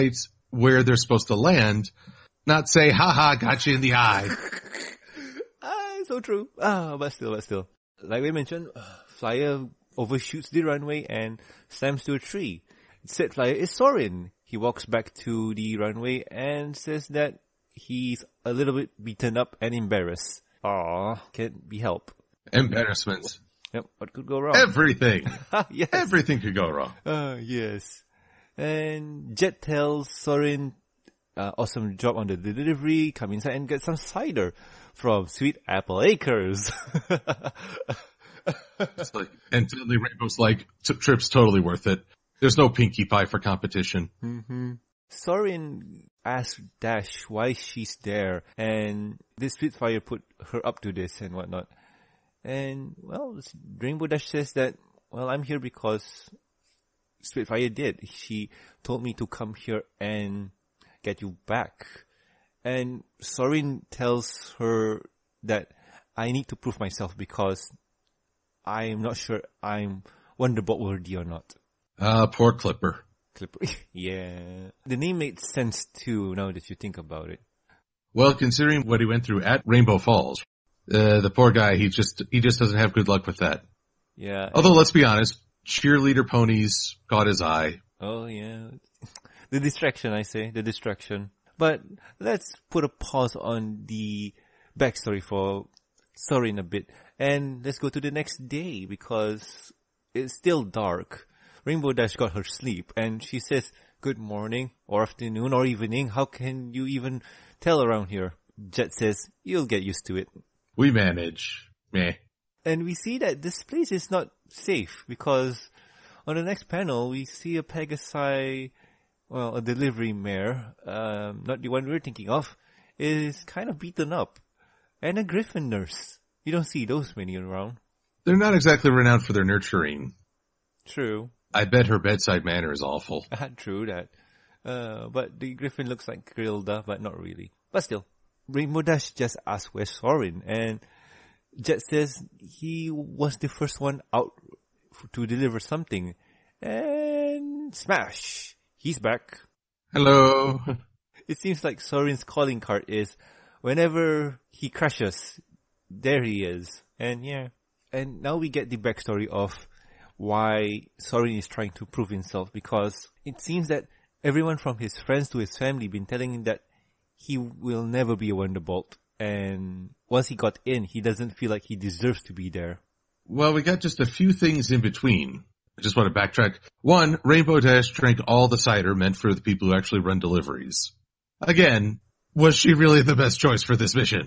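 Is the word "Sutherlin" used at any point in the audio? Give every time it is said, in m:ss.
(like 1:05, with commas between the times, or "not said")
not said.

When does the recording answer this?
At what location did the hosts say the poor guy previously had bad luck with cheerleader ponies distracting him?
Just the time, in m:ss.
1:19.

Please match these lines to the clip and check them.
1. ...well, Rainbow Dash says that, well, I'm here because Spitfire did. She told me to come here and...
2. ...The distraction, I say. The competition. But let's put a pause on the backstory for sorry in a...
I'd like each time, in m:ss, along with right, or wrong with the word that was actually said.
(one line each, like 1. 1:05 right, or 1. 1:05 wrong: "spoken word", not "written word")
1. 0:53 right
2. 1:29 wrong: "distraction", not "competition".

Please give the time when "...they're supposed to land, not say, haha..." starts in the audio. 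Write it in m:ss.
0:00.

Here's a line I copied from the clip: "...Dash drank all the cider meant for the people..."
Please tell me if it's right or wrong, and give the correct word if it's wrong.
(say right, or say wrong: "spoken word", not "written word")
right.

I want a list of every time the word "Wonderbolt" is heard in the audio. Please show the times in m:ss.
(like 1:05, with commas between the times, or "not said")
1:10, 2:48.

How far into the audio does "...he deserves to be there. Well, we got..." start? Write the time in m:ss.
2:51.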